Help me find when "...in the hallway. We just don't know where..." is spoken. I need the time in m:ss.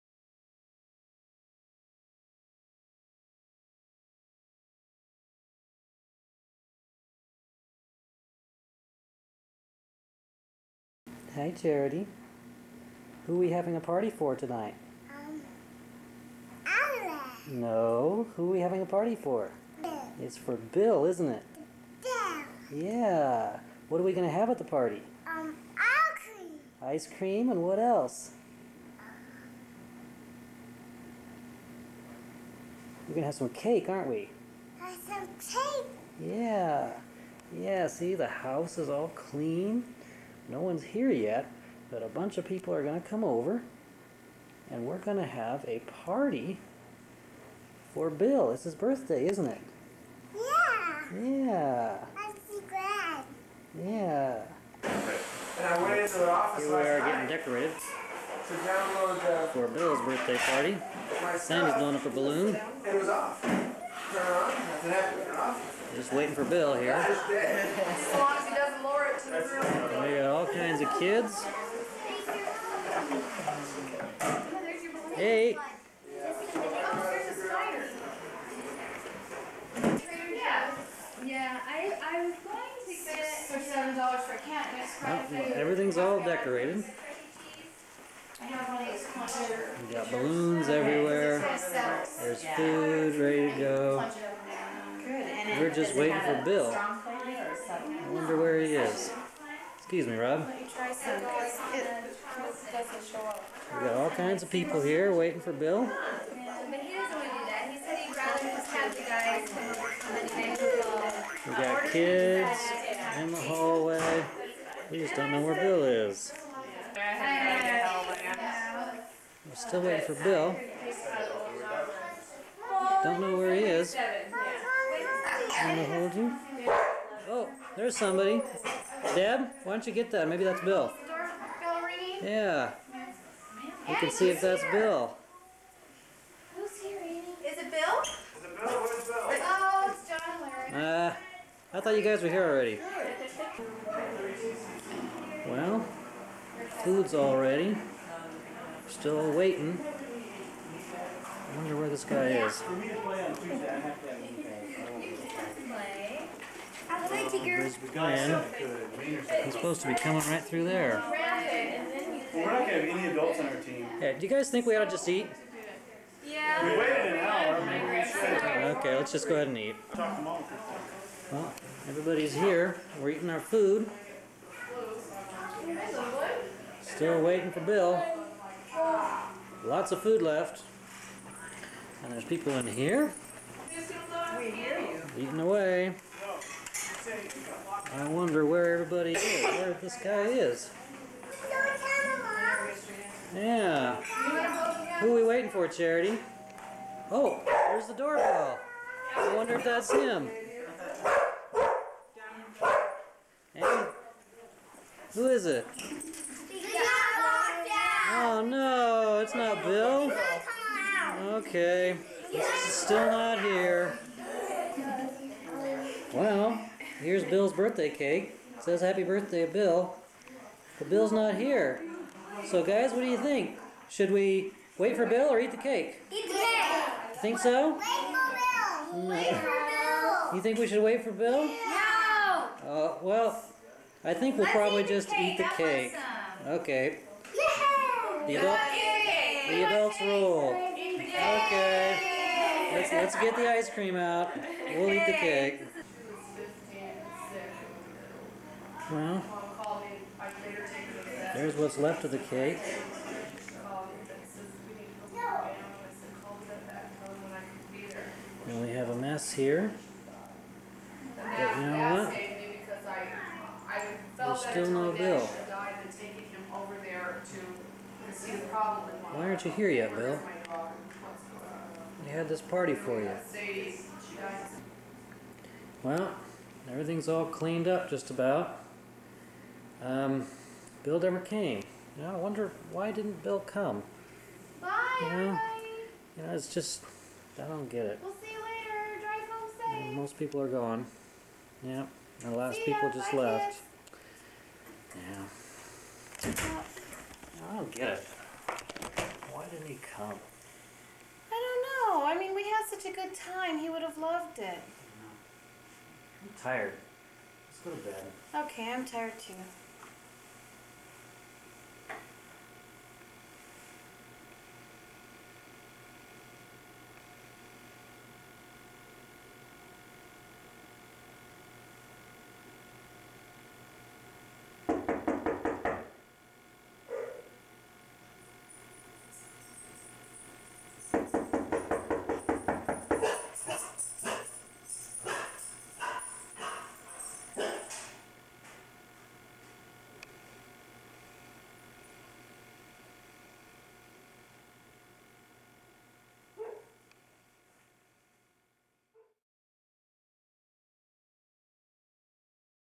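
1:53.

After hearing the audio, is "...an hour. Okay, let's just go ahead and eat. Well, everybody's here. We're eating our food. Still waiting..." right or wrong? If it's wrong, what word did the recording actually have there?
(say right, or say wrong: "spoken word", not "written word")
right.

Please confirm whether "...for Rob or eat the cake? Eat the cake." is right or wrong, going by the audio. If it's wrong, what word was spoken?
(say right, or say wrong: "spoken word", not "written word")
wrong: "Bill", not "Rob".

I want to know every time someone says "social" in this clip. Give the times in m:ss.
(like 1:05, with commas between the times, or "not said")
not said.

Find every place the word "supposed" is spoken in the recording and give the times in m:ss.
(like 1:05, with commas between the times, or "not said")
2:39.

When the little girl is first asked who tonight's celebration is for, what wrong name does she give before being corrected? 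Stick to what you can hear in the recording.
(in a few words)
Alice.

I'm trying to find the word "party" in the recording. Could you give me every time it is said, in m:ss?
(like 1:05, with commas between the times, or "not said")
0:13, 0:18, 0:24, 0:46, 1:00, 4:32.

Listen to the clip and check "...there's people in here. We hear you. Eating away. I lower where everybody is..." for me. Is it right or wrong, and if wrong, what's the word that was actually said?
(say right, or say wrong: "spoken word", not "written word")
wrong: "wonder", not "lower".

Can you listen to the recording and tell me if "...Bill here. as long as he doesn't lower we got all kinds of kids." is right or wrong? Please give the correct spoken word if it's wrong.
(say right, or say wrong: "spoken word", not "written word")
right.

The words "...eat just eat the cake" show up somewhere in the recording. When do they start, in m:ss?
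3:54.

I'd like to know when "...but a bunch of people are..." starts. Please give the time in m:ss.
0:41.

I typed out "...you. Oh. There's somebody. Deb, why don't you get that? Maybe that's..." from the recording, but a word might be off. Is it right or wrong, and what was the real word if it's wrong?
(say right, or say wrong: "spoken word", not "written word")
right.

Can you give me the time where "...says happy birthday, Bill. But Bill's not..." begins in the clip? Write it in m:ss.
3:38.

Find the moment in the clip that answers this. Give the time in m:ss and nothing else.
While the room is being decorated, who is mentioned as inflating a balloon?
1:01.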